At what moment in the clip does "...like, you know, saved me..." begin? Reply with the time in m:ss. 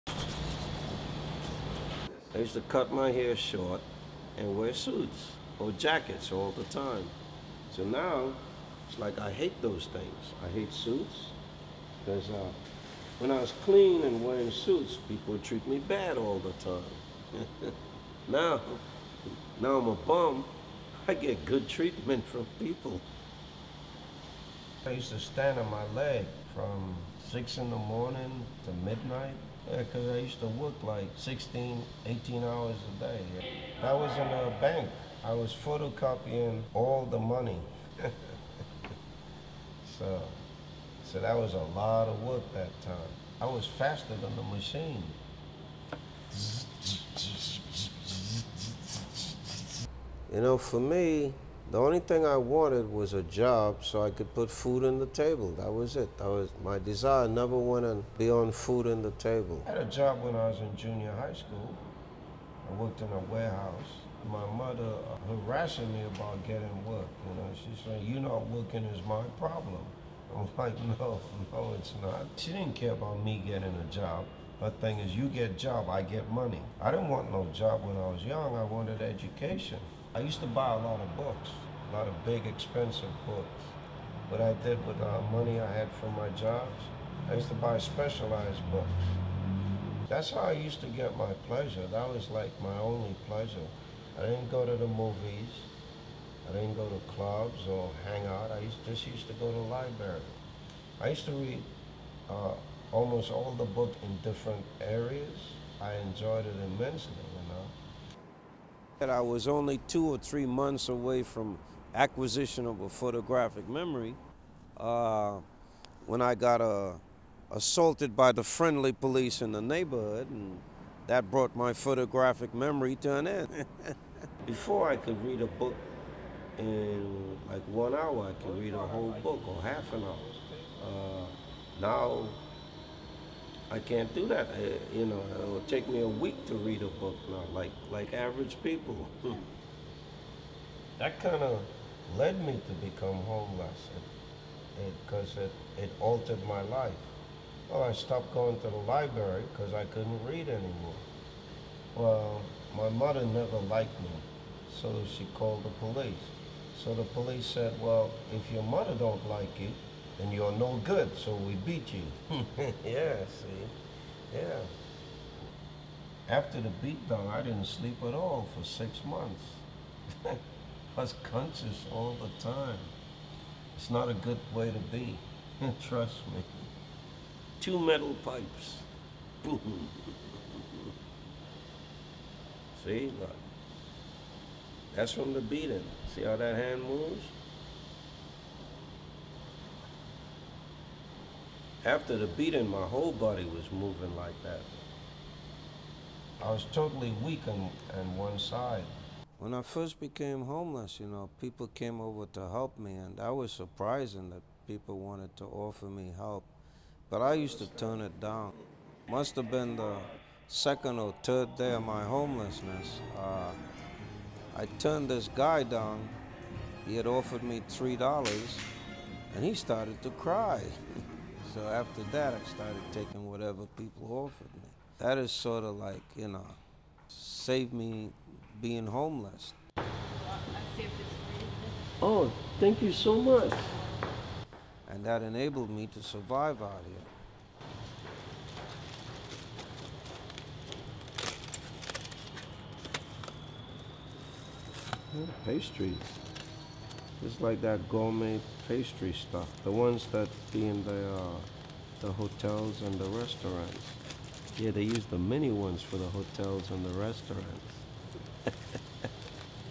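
3:45.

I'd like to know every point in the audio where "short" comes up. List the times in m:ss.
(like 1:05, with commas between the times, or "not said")
0:03.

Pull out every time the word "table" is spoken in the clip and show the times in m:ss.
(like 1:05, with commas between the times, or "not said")
0:55, 0:59.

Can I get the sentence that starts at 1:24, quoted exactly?
What I did with the uh, money I had from my jobs, I used to buy specialized books.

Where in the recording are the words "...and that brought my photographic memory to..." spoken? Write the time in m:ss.
2:00.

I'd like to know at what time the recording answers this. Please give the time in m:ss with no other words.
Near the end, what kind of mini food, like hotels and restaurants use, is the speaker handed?
4:05.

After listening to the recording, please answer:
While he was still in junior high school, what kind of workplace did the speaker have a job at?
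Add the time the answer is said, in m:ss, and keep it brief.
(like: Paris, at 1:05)
a warehouse, at 1:03.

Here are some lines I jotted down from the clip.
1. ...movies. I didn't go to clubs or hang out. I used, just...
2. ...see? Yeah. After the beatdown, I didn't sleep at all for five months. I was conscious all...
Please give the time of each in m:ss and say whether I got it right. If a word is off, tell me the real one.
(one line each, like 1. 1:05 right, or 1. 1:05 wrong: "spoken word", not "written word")
1. 1:34 right
2. 2:43 wrong: "six", not "five".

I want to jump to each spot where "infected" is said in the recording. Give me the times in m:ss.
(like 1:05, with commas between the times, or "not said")
not said.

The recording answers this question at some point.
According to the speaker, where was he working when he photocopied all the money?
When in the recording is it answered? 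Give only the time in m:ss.
0:33.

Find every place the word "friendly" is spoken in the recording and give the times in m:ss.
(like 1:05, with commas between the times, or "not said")
1:58.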